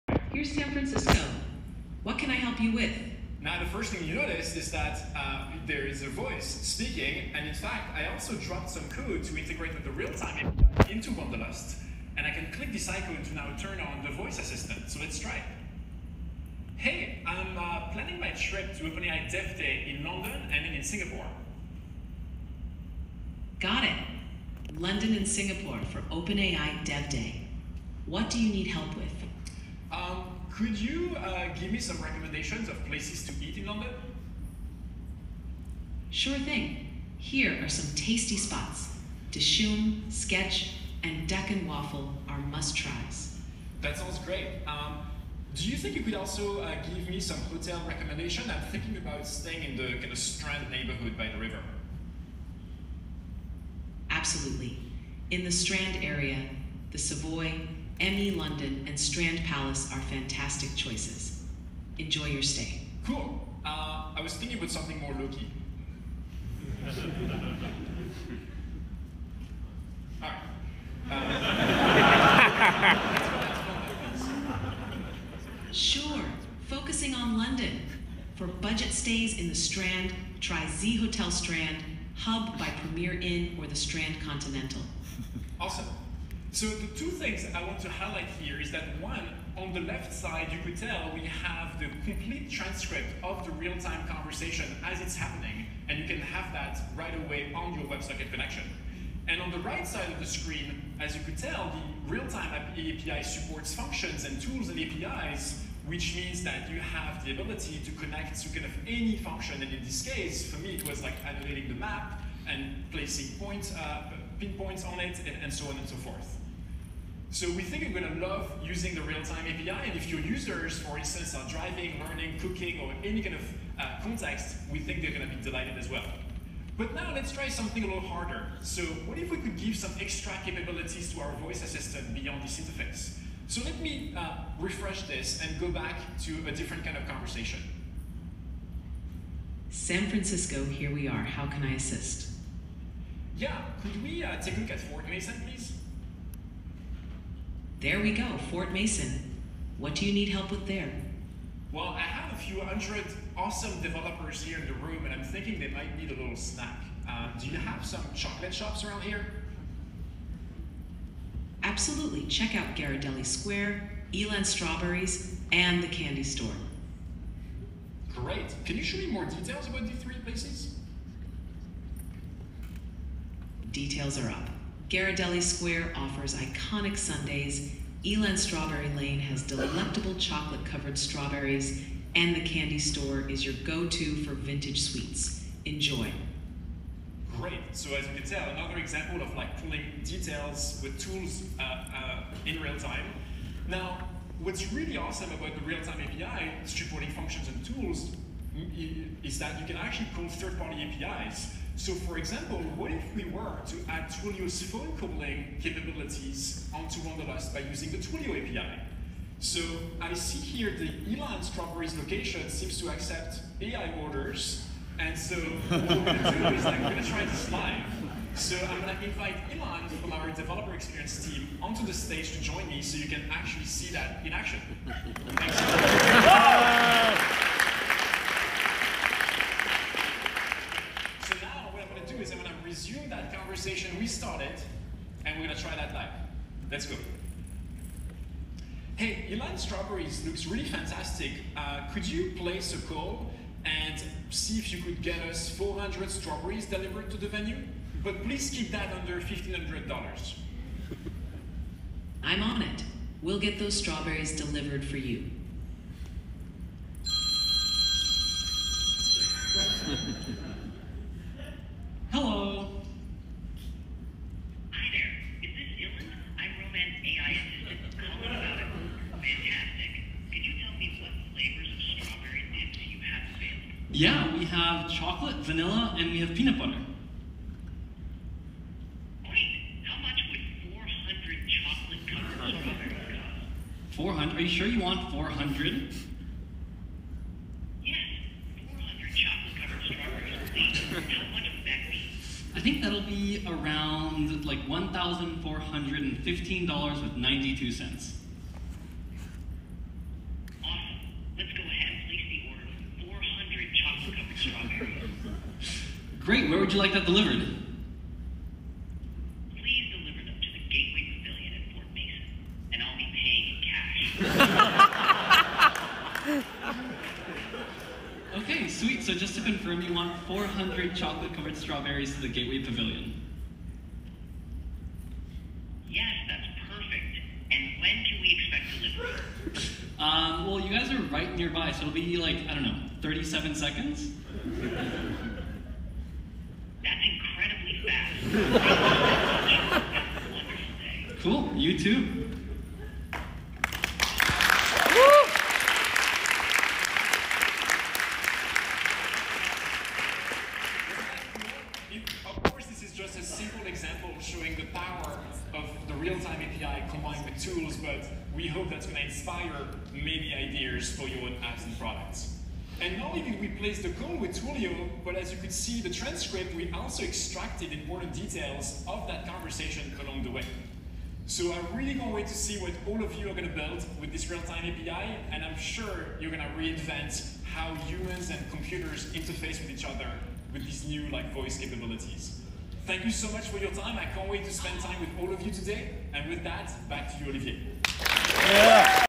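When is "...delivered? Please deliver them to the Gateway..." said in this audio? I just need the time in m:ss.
5:07.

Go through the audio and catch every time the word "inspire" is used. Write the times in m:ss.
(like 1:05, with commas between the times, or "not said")
5:59.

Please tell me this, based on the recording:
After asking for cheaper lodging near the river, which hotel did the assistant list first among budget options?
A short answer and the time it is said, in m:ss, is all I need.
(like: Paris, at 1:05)
Z Hotel Strand, at 1:20.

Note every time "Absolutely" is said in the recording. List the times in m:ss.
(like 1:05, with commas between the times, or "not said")
0:54, 2:41.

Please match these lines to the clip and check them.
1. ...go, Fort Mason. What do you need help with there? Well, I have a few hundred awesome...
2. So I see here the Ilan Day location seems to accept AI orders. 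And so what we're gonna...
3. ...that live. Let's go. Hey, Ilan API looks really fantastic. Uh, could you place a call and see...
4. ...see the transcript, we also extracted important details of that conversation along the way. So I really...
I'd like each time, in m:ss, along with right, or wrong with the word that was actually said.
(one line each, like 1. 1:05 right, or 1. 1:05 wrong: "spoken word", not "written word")
1. 2:28 right
2. 3:29 wrong: "Strawberries", not "Day"
3. 3:55 wrong: "Strawberries", not "API"
4. 6:05 right.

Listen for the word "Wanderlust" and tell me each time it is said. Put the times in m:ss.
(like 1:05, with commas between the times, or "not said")
0:11, 3:27.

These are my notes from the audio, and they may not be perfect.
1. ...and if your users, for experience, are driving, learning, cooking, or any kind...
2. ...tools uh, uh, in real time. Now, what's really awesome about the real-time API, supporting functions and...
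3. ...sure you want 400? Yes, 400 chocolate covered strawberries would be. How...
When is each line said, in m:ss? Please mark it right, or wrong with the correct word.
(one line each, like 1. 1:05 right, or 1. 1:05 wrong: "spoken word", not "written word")
1. 1:59 wrong: "instance", not "experience"
2. 3:10 right
3. 4:44 right.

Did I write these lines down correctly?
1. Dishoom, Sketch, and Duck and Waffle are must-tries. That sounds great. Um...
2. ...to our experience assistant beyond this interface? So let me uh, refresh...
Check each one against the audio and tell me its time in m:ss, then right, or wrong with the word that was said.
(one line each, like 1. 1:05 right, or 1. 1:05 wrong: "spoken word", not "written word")
1. 0:39 right
2. 2:11 wrong: "voice", not "experience".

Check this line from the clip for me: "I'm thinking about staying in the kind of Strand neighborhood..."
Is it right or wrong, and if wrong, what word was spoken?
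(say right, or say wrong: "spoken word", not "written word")
right.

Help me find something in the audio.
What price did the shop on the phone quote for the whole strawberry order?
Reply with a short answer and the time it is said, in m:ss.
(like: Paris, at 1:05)
$1,415.92, at 4:54.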